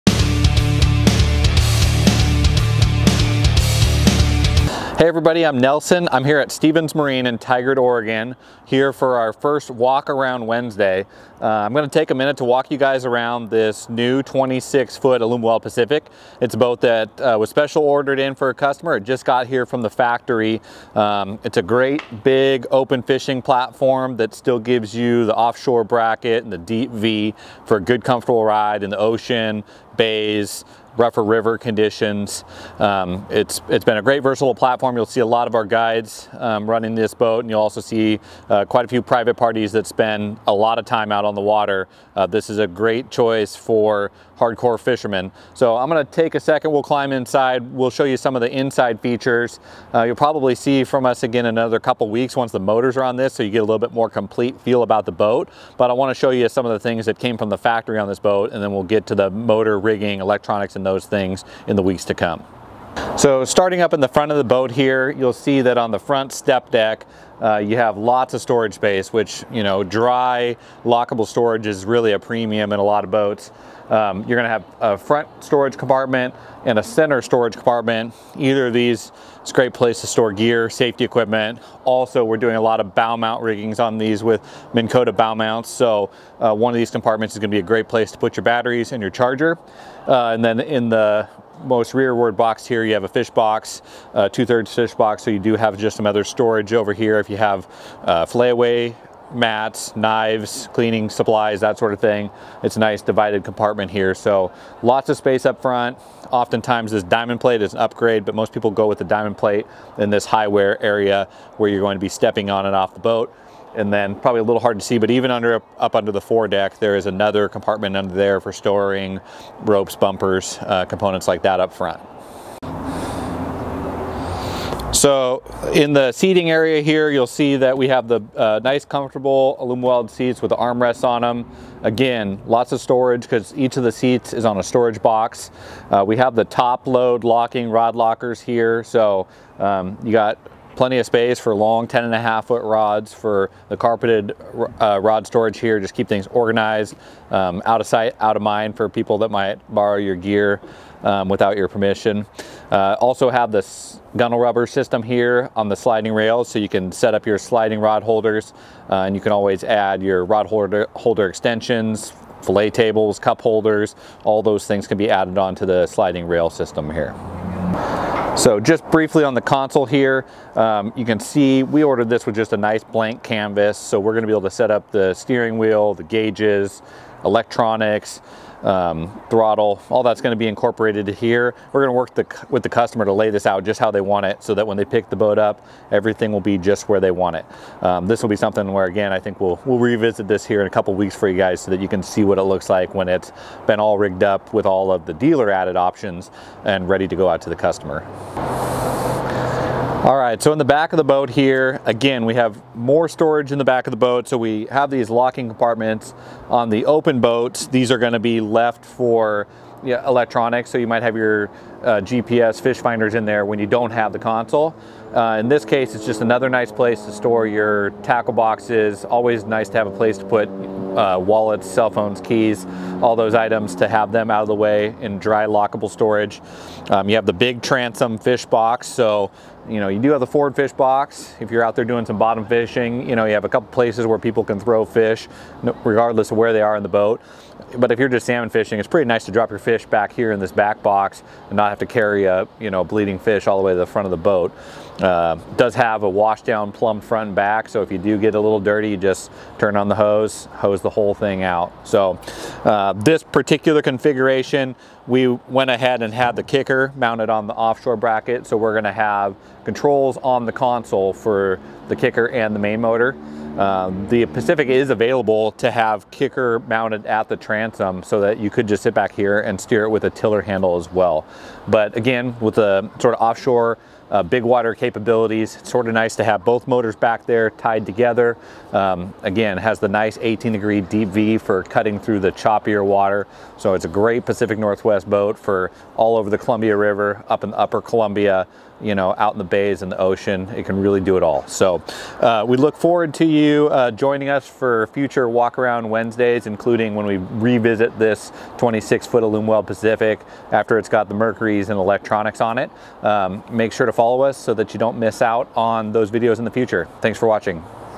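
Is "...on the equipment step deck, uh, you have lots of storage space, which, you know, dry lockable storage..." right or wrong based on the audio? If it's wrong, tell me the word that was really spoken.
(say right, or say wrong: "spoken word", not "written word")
wrong: "front", not "equipment".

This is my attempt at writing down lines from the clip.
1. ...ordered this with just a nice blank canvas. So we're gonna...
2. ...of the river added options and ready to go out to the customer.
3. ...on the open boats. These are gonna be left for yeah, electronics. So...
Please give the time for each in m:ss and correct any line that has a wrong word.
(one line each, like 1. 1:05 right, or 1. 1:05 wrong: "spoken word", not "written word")
1. 2:51 right
2. 3:14 wrong: "dealer", not "river"
3. 3:26 right.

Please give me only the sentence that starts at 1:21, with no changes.
Also, we're doing a lot of bow mount riggings on these with Minn Kota bow mounts.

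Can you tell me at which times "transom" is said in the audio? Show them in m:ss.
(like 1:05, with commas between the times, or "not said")
3:47, 4:27.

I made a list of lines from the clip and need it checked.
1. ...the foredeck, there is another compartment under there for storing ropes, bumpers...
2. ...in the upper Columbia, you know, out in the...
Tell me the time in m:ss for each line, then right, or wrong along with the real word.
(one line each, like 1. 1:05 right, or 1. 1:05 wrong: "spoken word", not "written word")
1. 1:56 right
2. 4:47 right.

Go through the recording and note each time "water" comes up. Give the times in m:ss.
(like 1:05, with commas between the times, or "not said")
0:41, 4:34, 4:42.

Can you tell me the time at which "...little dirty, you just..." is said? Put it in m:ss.
4:08.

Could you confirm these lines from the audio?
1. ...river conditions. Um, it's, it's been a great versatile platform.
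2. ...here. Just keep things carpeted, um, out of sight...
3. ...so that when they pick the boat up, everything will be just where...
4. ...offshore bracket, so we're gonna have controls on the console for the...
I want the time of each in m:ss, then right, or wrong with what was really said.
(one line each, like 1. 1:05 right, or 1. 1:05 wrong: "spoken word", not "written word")
1. 0:31 right
2. 2:25 wrong: "organized", not "carpeted"
3. 3:04 right
4. 4:17 right.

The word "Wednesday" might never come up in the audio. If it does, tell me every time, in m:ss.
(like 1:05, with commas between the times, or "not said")
0:10, 4:55.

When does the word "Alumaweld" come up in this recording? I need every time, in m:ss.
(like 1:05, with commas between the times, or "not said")
0:15, 2:09, 4:59.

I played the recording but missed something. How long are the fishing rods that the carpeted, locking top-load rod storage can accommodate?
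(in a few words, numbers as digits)
10.5 feet.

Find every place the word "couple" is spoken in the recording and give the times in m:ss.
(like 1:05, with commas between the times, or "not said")
0:51, 3:10, 3:53.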